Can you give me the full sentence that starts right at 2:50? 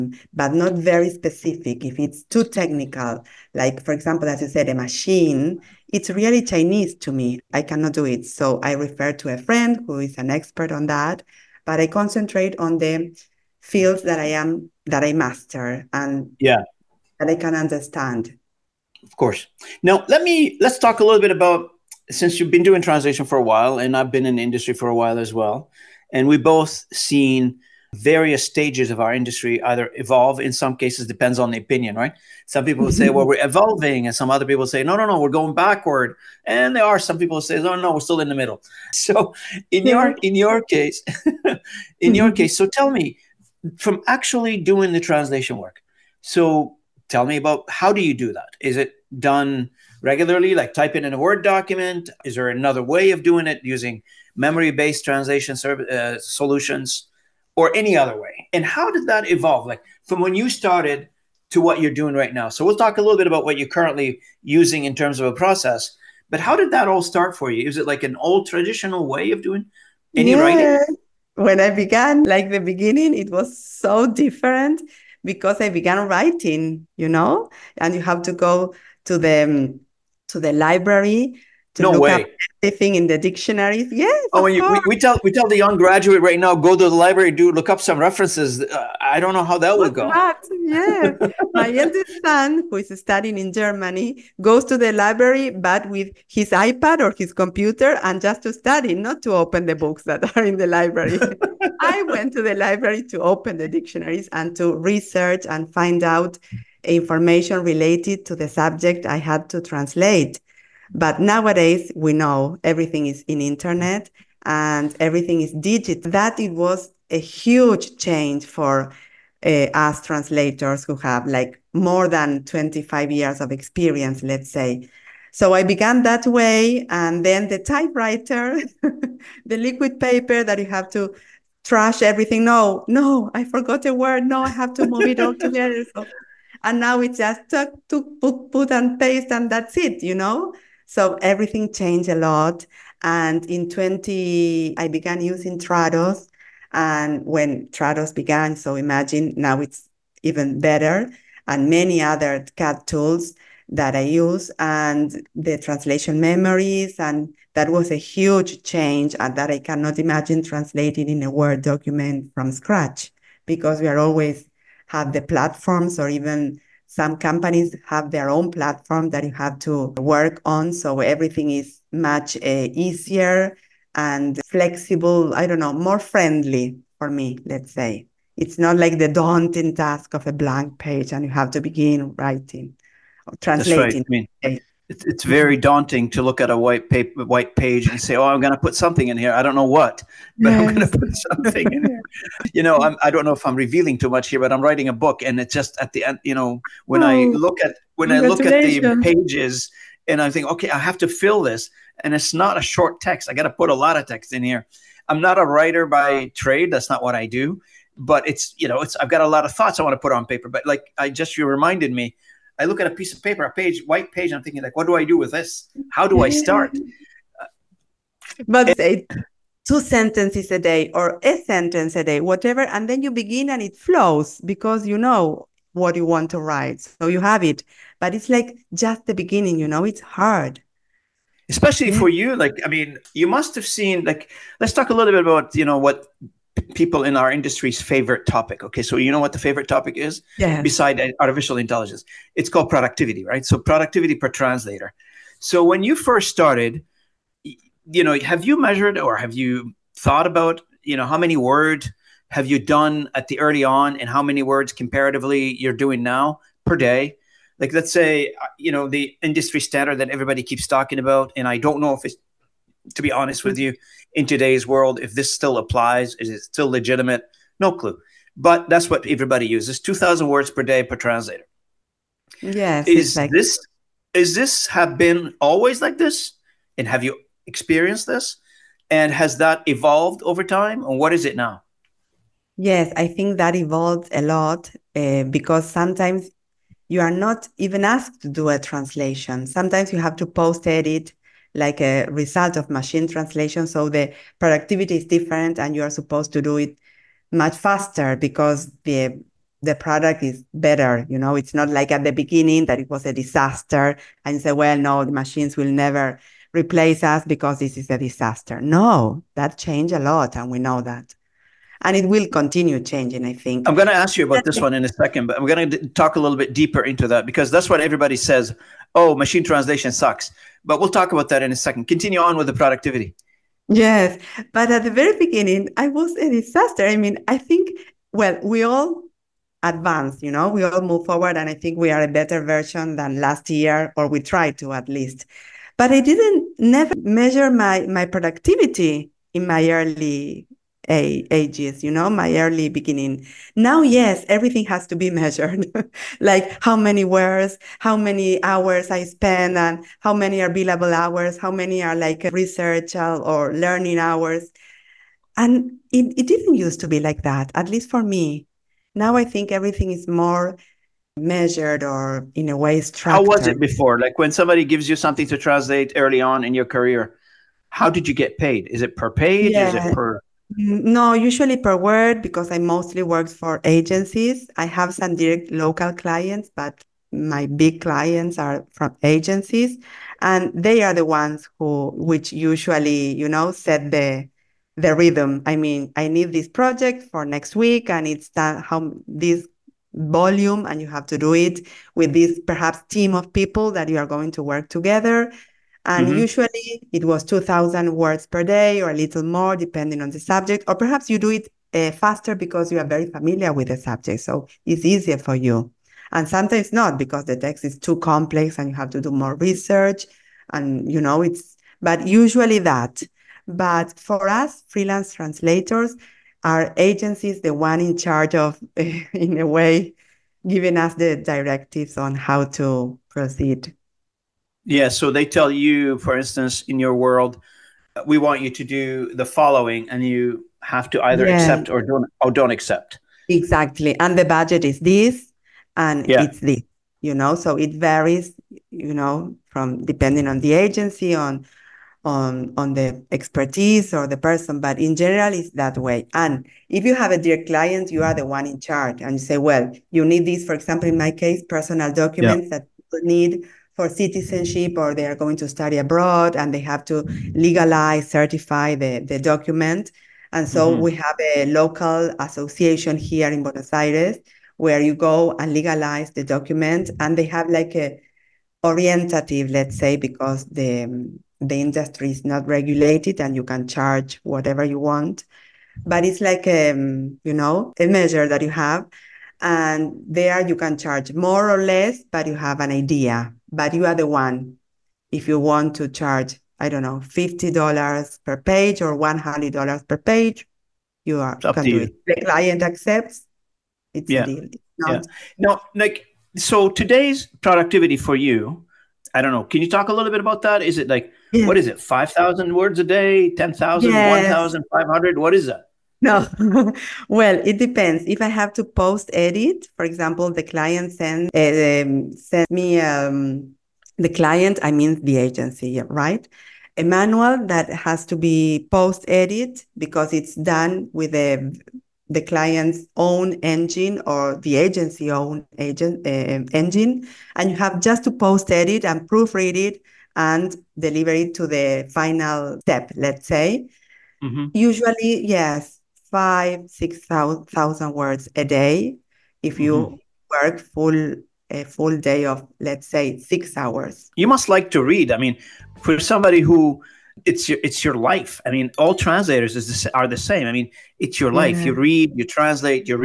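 So everything is much uh, easier and flexible.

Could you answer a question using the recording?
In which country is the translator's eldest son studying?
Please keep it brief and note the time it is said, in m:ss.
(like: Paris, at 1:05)
Germany, at 1:33.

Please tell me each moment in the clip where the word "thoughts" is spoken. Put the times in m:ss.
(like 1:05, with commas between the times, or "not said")
3:29, 4:09.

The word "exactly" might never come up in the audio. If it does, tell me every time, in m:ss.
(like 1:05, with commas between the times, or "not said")
4:33, 7:13.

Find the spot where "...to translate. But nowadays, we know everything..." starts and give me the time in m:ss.
1:49.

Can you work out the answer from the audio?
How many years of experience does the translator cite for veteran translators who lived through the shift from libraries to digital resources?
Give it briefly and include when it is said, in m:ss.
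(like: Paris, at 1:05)
25, at 2:02.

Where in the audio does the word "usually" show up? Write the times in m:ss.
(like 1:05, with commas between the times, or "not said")
6:11, 6:22, 6:36, 6:52, 8:54.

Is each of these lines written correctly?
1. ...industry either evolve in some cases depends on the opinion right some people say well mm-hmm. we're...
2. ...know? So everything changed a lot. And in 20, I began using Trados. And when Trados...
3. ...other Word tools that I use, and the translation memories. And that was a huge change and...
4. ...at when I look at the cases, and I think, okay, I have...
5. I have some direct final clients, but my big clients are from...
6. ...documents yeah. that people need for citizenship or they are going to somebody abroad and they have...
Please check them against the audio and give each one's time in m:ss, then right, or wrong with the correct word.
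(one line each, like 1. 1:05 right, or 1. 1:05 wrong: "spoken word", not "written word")
1. 0:29 right
2. 2:20 right
3. 2:32 wrong: "CAT", not "Word"
4. 3:17 wrong: "pages", not "cases"
5. 6:14 wrong: "local", not "final"
6. 7:31 wrong: "study", not "somebody".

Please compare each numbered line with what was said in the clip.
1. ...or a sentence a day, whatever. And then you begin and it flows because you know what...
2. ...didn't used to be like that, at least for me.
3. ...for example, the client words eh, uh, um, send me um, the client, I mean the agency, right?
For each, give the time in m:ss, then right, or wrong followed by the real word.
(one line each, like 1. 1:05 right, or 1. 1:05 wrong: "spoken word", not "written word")
1. 3:40 right
2. 5:56 right
3. 8:29 wrong: "sends", not "words".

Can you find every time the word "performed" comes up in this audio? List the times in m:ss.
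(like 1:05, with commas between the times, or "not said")
not said.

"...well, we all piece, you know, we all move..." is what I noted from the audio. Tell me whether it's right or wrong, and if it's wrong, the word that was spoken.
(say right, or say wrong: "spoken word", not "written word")
wrong: "advance", not "piece".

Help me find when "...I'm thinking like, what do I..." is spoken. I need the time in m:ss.
3:34.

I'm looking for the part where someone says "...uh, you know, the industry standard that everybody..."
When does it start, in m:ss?
4:18.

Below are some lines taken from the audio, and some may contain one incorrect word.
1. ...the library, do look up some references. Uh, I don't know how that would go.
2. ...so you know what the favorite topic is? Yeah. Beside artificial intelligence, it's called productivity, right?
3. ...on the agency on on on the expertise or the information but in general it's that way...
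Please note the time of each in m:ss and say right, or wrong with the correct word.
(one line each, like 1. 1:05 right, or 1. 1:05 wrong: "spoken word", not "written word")
1. 1:26 right
2. 3:58 right
3. 7:20 wrong: "person", not "information".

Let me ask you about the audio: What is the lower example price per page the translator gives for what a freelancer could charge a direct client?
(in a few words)
$50.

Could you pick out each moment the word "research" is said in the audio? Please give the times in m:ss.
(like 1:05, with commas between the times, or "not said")
1:44, 5:52, 6:49.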